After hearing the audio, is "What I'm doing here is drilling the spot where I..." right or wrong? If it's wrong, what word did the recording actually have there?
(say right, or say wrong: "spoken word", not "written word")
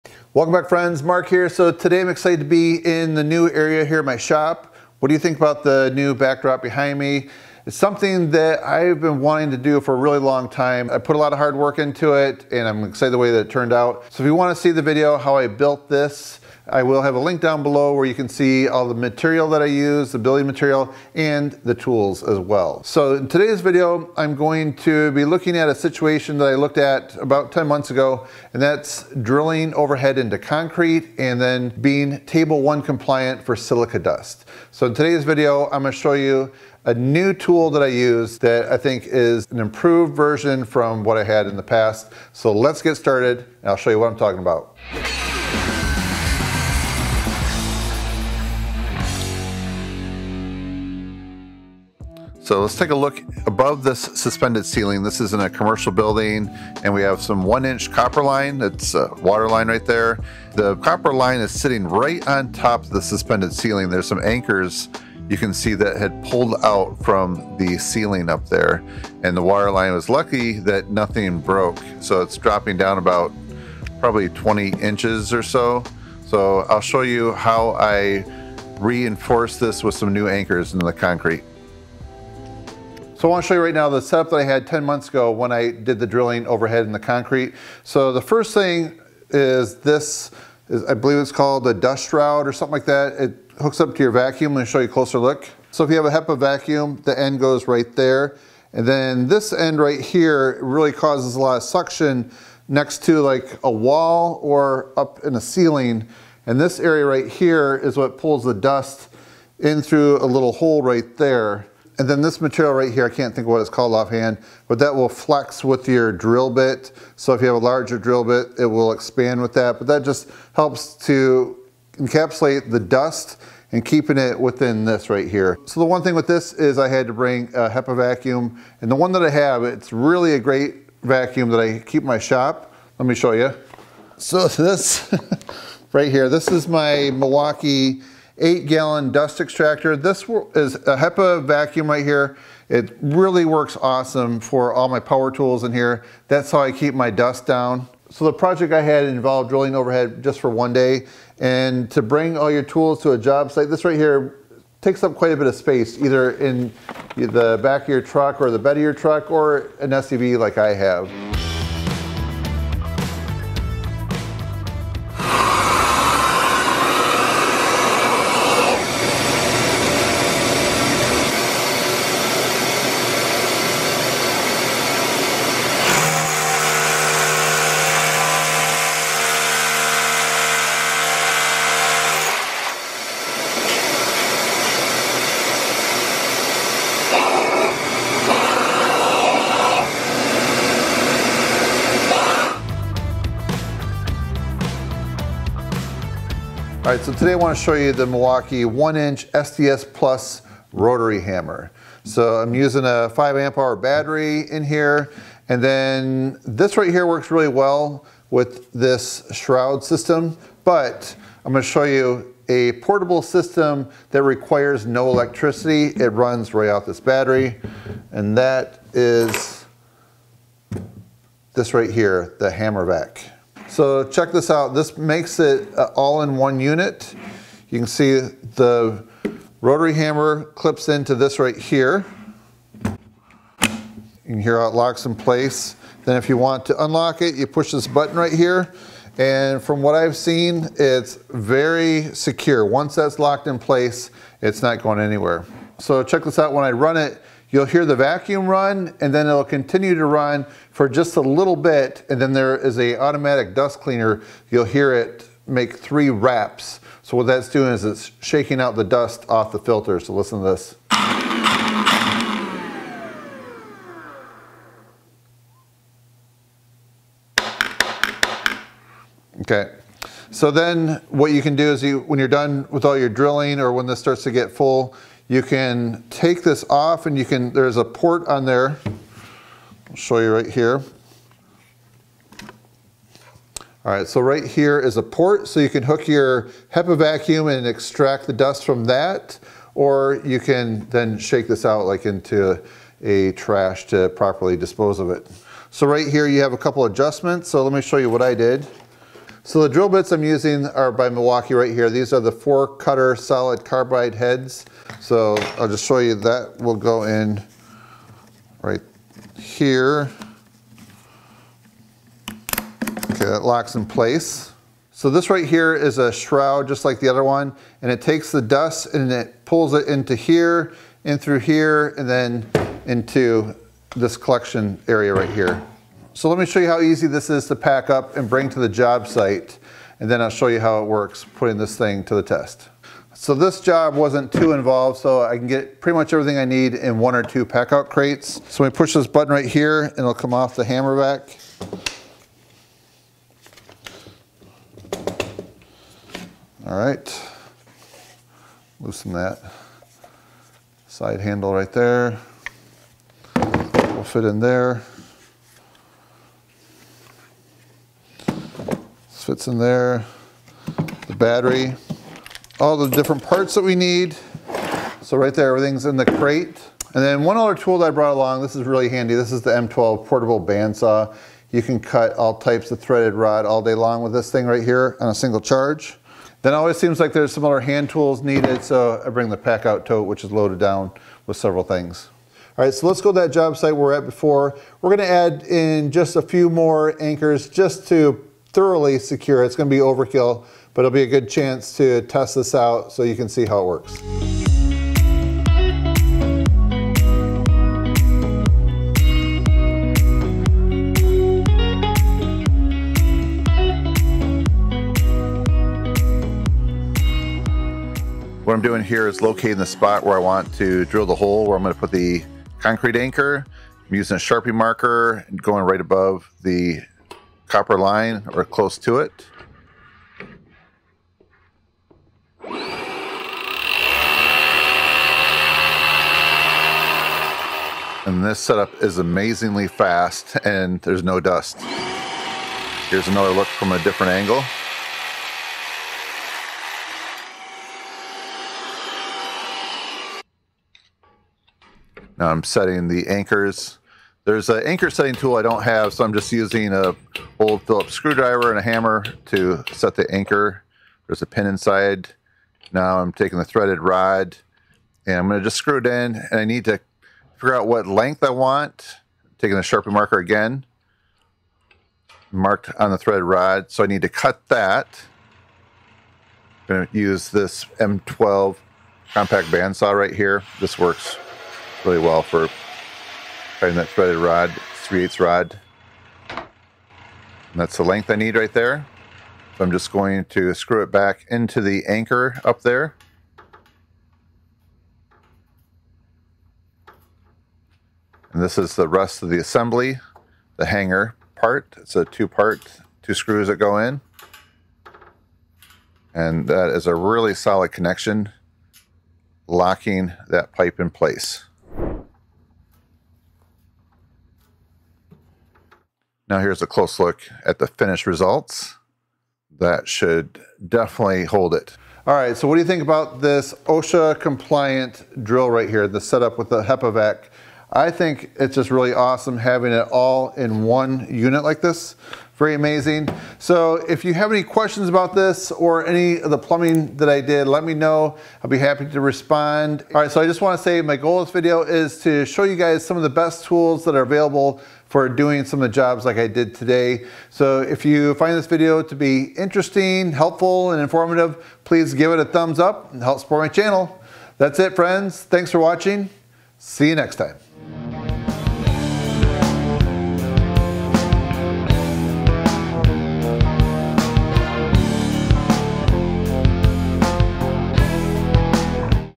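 wrong: "locating", not "drilling".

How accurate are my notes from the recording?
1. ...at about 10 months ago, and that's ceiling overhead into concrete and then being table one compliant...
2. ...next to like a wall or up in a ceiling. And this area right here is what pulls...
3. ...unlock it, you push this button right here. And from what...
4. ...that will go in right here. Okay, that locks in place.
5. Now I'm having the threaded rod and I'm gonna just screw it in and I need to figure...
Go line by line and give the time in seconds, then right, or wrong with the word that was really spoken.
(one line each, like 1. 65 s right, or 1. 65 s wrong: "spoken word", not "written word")
1. 26 s wrong: "drilling", not "ceiling"
2. 102 s right
3. 236 s right
4. 306 s right
5. 452 s wrong: "taking", not "having".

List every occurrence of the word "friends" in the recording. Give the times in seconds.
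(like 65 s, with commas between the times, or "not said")
0 s, 544 s.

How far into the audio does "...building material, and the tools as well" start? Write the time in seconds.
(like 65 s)
20 s.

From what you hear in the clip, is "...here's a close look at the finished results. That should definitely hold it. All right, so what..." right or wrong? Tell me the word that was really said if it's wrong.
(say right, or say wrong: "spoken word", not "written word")
right.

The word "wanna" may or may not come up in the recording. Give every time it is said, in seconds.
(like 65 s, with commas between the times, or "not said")
14 s, 530 s.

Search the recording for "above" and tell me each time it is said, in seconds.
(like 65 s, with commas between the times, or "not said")
53 s, 415 s.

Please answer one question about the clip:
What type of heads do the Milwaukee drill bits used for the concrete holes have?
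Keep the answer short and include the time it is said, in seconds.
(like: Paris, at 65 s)
four cutter solid carbide, at 302 s.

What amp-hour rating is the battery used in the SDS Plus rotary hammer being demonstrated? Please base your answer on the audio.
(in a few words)
5 amp hour.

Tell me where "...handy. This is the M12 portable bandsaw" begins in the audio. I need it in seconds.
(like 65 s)
368 s.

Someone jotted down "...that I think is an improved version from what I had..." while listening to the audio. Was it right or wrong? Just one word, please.
right.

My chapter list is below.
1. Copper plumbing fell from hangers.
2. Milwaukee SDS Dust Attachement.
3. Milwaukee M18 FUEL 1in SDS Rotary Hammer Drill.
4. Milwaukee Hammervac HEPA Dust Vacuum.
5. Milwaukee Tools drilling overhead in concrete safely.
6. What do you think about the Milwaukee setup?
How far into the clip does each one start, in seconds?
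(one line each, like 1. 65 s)
1. 50 s
2. 83 s
3. 196 s
4. 223 s
5. 404 s
6. 530 s.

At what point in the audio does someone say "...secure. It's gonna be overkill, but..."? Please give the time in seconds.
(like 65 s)
388 s.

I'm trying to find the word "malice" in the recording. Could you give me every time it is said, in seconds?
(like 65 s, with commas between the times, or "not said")
not said.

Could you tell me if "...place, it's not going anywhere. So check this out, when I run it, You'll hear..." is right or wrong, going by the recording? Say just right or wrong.
right.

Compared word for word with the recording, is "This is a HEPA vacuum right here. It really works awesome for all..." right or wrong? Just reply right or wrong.
right.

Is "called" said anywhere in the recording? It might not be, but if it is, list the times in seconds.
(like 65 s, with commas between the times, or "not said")
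91 s, 113 s.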